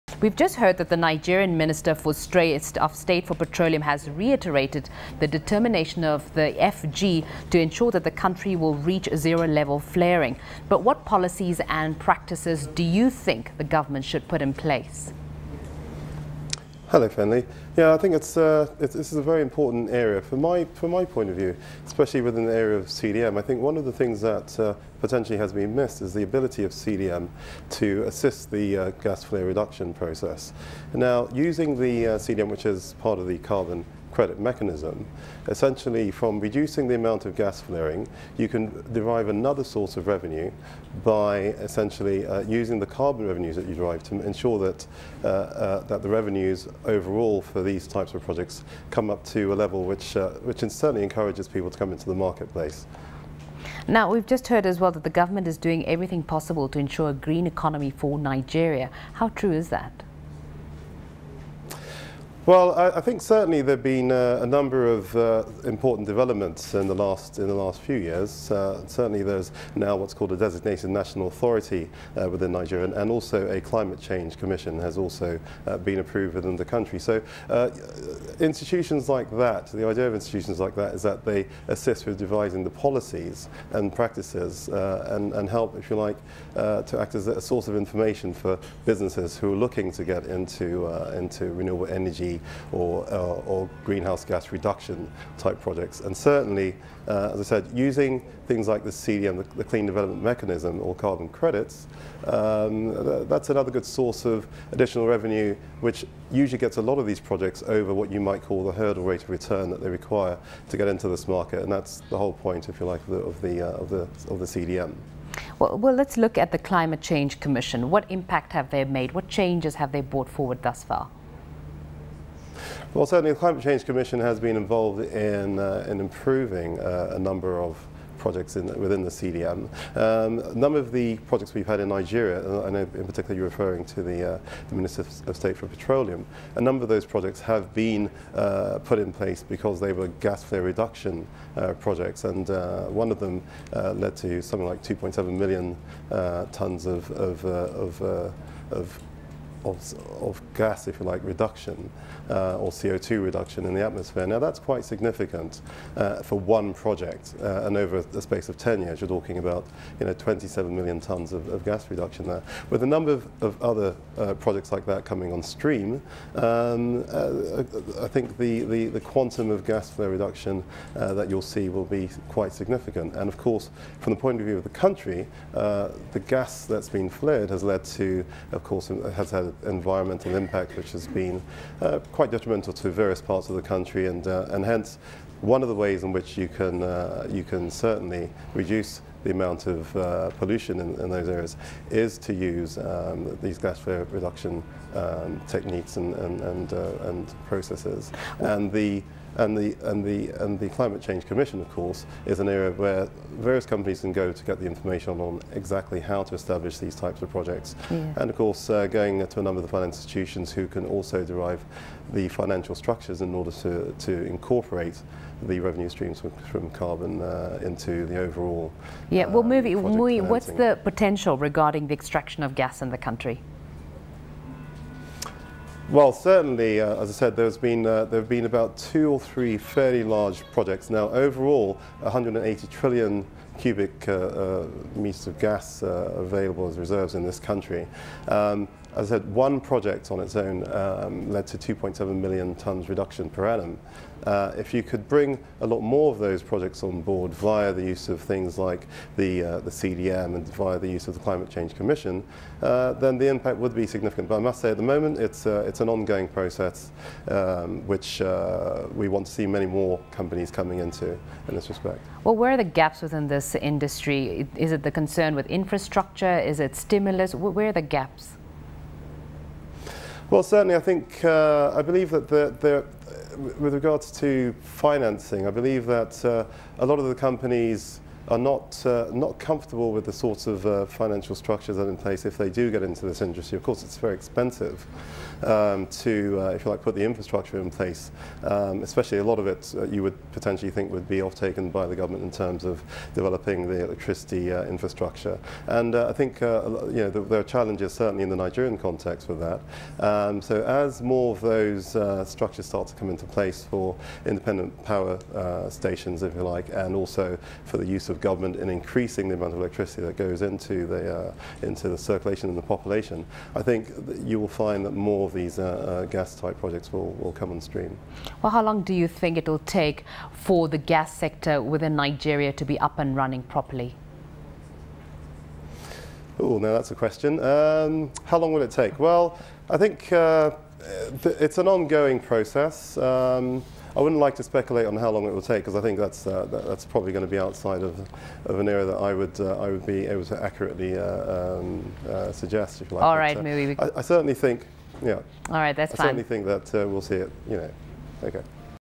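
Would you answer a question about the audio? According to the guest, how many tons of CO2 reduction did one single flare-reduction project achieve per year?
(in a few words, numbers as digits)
2.7 million tons.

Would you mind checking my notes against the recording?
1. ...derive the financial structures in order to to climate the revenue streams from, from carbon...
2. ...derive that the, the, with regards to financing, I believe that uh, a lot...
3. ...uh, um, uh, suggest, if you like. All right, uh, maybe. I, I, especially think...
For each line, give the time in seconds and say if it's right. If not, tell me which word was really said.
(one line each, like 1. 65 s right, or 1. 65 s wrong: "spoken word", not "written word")
1. 211 s wrong: "incorporate", not "climate"
2. 271 s wrong: "believe", not "derive"
3. 340 s wrong: "certainly", not "especially".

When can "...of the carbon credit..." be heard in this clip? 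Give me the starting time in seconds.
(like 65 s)
33 s.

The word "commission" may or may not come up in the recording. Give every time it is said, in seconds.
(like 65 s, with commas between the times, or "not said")
74 s, 117 s, 123 s, 201 s, 251 s.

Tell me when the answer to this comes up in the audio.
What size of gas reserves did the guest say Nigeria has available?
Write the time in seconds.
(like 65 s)
231 s.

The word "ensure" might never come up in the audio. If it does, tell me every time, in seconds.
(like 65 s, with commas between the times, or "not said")
7 s, 44 s, 56 s.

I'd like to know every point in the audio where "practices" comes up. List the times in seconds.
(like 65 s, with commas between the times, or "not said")
11 s, 83 s.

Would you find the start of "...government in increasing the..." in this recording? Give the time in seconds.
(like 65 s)
308 s.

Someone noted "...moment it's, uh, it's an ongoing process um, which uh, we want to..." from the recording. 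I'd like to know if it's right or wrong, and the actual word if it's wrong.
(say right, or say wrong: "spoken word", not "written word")
right.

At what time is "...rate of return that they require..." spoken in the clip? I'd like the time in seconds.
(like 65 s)
109 s.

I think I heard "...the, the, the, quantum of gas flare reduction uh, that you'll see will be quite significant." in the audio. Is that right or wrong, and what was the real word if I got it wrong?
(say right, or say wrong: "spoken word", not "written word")
right.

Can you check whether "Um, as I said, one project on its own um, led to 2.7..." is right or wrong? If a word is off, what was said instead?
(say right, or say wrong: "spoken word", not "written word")
right.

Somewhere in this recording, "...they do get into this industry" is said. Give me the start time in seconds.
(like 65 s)
282 s.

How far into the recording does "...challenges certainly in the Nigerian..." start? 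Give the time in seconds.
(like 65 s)
297 s.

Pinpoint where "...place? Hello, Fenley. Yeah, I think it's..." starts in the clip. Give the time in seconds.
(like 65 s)
14 s.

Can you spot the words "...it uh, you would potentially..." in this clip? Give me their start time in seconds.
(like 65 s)
289 s.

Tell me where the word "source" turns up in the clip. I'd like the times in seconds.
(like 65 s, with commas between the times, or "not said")
39 s, 87 s, 103 s.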